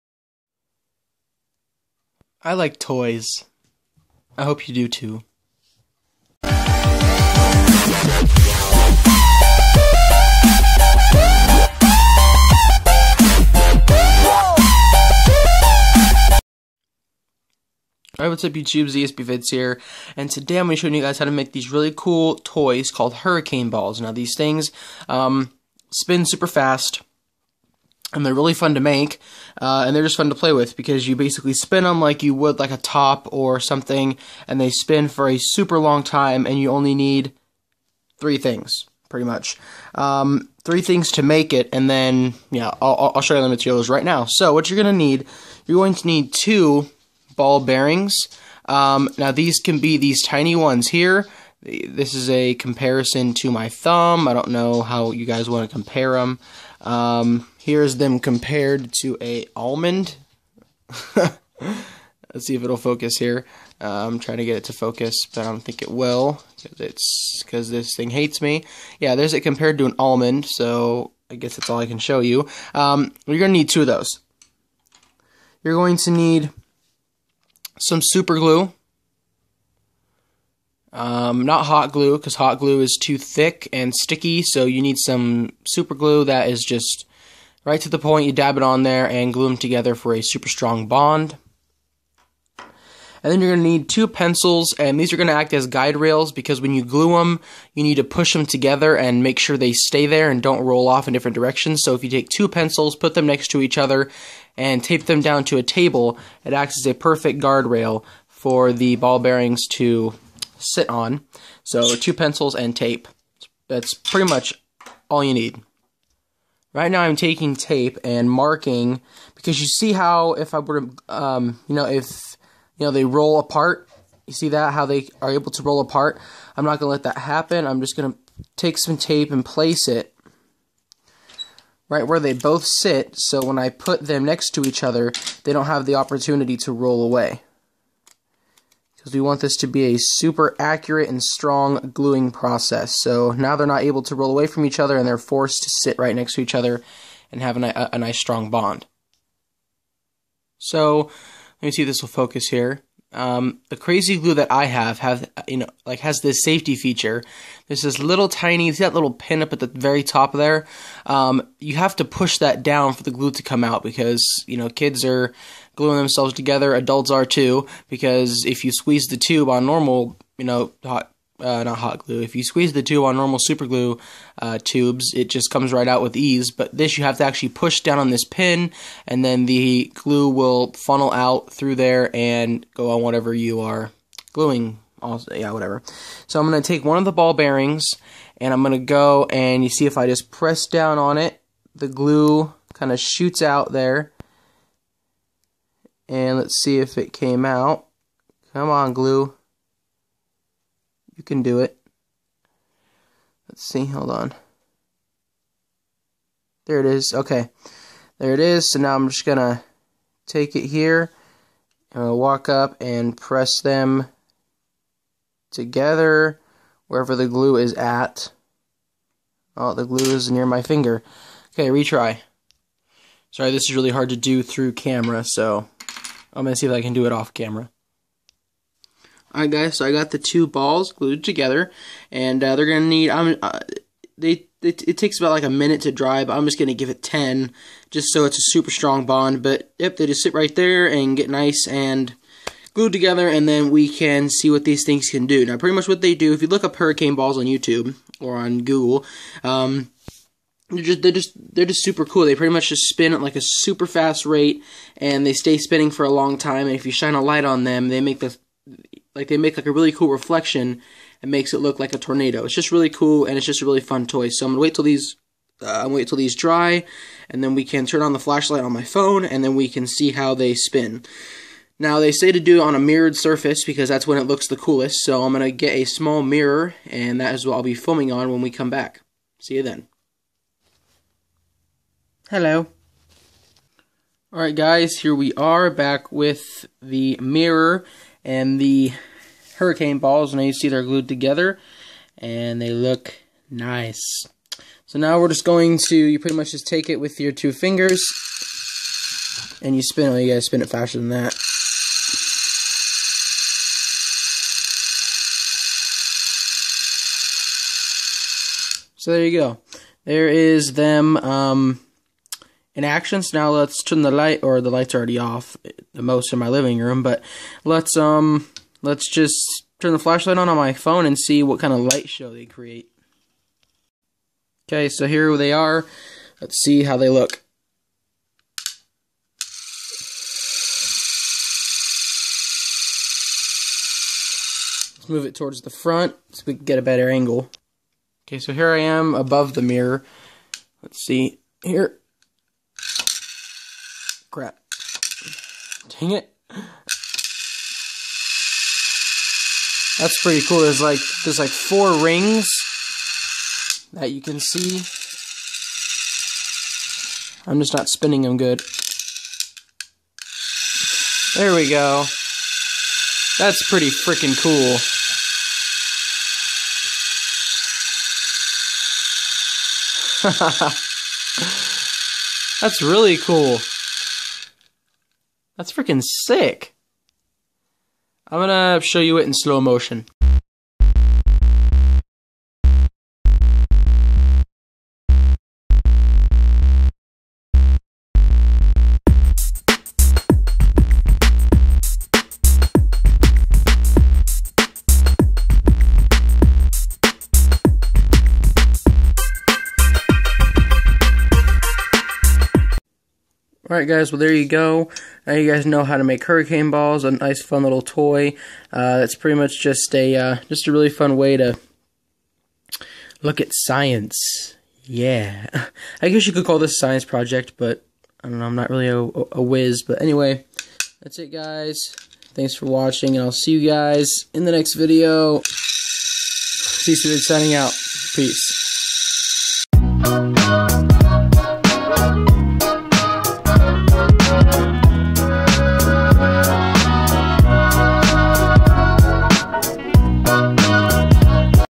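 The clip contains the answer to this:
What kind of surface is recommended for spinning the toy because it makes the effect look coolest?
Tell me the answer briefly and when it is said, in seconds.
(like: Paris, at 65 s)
A mirrored surface, at 272 s.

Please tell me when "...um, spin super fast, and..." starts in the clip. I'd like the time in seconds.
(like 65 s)
25 s.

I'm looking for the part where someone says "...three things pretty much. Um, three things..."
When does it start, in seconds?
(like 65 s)
38 s.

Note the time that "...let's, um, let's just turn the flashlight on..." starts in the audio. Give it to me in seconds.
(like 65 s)
317 s.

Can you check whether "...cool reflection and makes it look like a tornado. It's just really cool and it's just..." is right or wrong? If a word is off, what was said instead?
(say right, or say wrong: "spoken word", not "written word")
right.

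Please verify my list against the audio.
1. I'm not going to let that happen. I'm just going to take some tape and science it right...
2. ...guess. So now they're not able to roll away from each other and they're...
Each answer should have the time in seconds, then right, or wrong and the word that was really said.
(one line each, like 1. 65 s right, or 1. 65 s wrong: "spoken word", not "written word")
1. 126 s wrong: "place", not "science"
2. 142 s wrong: "process", not "guess".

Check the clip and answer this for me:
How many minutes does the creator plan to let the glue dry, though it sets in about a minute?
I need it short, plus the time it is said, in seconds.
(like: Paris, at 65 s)
10, at 237 s.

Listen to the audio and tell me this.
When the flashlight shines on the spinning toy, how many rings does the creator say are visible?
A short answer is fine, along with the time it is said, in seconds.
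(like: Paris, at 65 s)
4, at 351 s.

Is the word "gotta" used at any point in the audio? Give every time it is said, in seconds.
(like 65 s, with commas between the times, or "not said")
300 s.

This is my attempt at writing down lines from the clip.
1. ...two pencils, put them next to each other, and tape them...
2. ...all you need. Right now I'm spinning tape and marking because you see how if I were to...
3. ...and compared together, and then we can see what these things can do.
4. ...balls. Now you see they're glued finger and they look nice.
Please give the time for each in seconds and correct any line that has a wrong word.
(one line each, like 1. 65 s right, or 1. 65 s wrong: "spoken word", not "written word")
1. 102 s right
2. 115 s wrong: "taking", not "spinning"
3. 241 s wrong: "glued", not "compared"
4. 289 s wrong: "together", not "finger".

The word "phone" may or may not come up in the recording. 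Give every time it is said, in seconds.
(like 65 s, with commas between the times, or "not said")
268 s, 320 s.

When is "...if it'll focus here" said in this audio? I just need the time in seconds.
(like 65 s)
62 s.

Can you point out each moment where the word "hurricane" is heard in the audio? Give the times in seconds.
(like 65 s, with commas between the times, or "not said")
23 s, 246 s, 289 s, 406 s.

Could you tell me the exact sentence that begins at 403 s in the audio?
Alright guys, well there you go.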